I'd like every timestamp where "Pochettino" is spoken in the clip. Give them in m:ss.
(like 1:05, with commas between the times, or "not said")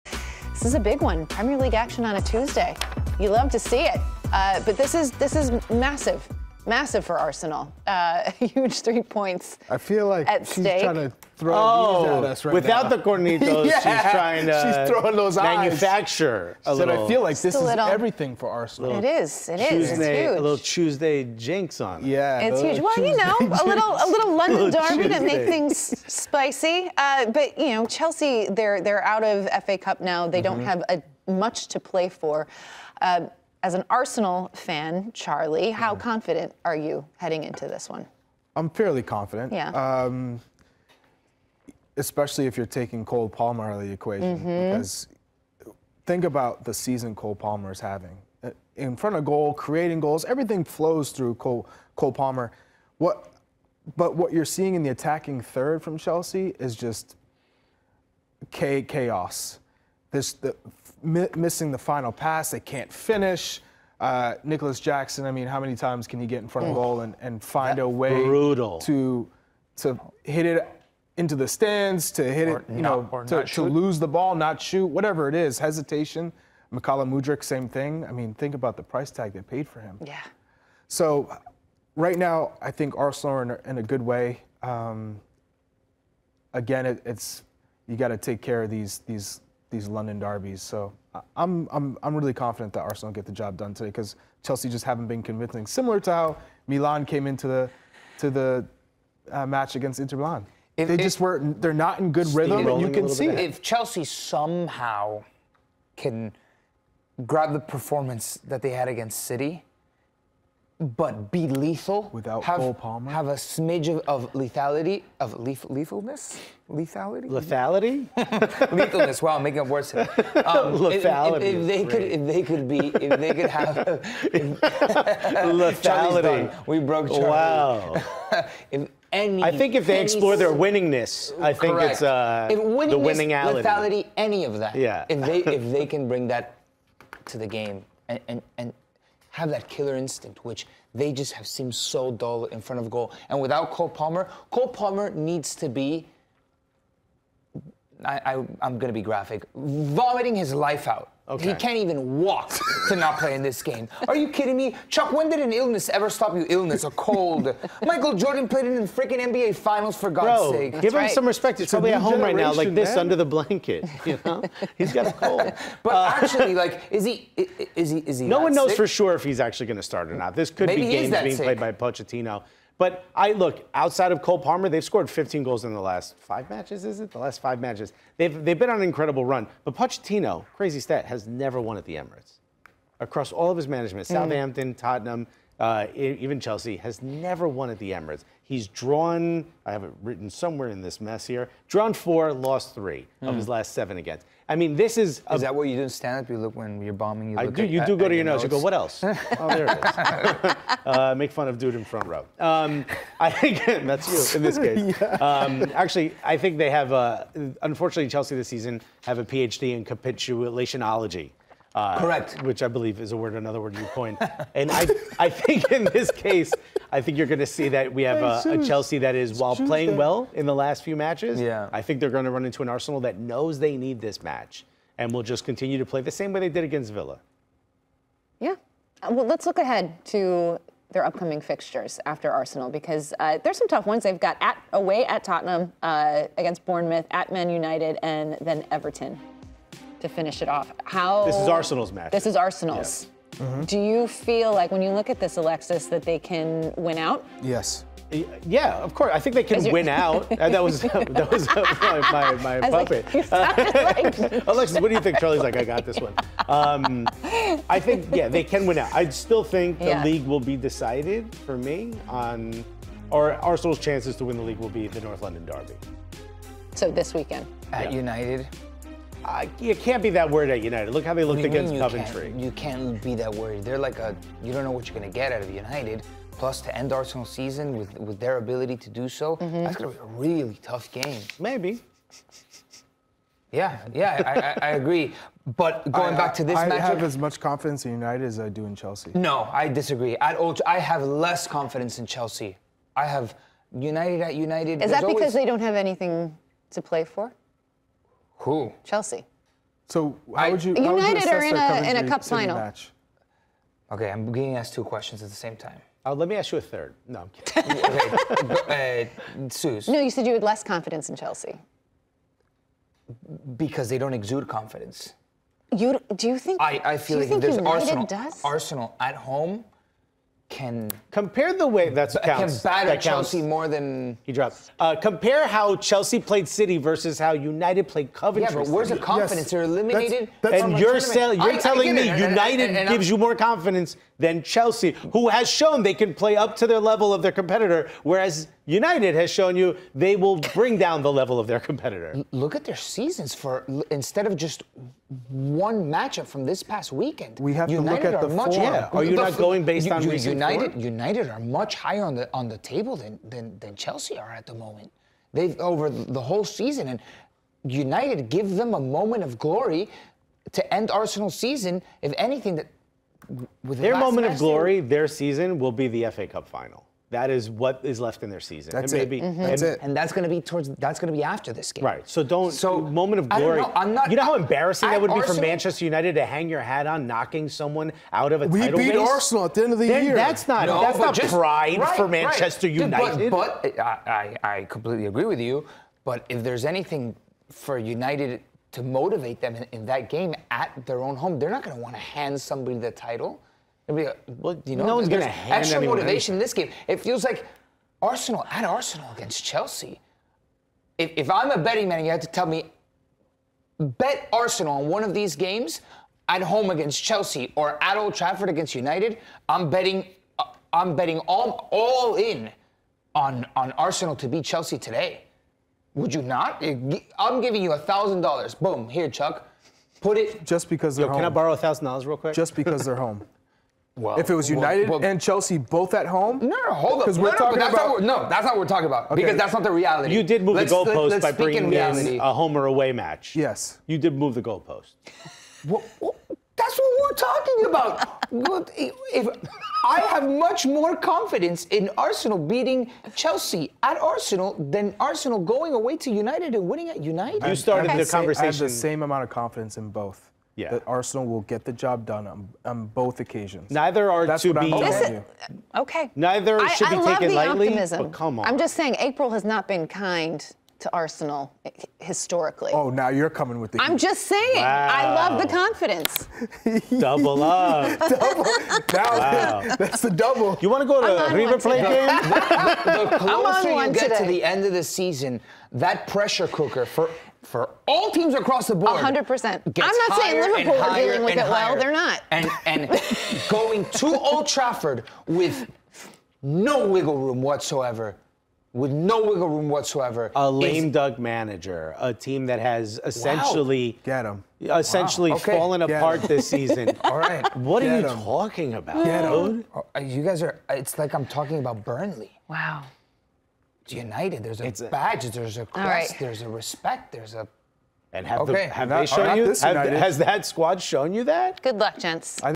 2:51, 2:59.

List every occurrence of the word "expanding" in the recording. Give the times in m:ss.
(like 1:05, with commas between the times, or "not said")
not said.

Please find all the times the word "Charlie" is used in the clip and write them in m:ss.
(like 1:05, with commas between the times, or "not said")
0:35, 2:07, 4:15.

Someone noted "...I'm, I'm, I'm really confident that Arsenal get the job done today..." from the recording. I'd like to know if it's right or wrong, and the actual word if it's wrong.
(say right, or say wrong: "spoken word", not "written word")
right.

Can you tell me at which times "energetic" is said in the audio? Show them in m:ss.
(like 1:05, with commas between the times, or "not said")
not said.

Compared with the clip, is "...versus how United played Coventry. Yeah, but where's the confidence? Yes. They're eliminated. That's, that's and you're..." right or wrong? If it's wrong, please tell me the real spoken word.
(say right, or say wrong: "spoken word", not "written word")
right.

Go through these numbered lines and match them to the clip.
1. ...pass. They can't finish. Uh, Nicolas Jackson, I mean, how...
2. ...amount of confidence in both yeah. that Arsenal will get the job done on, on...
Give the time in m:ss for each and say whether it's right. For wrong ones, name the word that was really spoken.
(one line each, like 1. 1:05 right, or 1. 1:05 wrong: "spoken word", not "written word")
1. 1:02 right
2. 7:29 right.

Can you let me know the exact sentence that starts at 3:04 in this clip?
Southampton, Tottenham, uh, even Chelsea, has never won at the Emirates.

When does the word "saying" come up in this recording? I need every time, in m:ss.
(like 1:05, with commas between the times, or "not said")
7:38, 7:44, 8:00.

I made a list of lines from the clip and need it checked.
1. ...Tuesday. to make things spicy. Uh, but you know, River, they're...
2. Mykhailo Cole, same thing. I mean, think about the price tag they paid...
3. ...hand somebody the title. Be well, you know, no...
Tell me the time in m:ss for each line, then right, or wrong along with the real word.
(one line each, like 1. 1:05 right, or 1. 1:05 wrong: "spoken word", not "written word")
1. 0:25 wrong: "Chelsea", not "River"
2. 1:16 wrong: "Mudryk", not "Cole"
3. 6:32 right.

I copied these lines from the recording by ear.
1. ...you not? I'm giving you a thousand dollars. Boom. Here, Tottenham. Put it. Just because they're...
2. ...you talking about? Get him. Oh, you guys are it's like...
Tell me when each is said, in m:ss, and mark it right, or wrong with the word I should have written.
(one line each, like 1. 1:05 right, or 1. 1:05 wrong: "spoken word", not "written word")
1. 6:56 wrong: "Chuck", not "Tottenham"
2. 8:18 right.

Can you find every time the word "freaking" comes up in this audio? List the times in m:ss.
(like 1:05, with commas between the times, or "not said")
2:38.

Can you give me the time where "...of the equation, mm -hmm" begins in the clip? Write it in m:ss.
0:43.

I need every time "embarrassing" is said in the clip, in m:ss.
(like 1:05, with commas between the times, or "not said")
6:14.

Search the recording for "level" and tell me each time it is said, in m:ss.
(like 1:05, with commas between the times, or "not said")
5:36, 5:41.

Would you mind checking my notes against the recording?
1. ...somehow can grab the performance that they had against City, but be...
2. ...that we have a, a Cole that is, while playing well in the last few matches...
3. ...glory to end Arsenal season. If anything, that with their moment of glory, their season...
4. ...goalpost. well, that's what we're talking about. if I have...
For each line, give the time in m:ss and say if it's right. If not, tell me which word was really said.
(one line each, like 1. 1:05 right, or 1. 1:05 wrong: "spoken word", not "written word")
1. 1:44 right
2. 3:37 wrong: "Chelsea", not "Cole"
3. 5:59 right
4. 7:14 right.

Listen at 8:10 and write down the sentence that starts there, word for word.
A lame is, duck manager, a team that has essentially wow.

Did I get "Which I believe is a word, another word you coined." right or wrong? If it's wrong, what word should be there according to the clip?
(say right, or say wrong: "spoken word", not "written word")
right.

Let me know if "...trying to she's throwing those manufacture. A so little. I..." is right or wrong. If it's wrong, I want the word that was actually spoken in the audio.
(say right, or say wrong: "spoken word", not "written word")
right.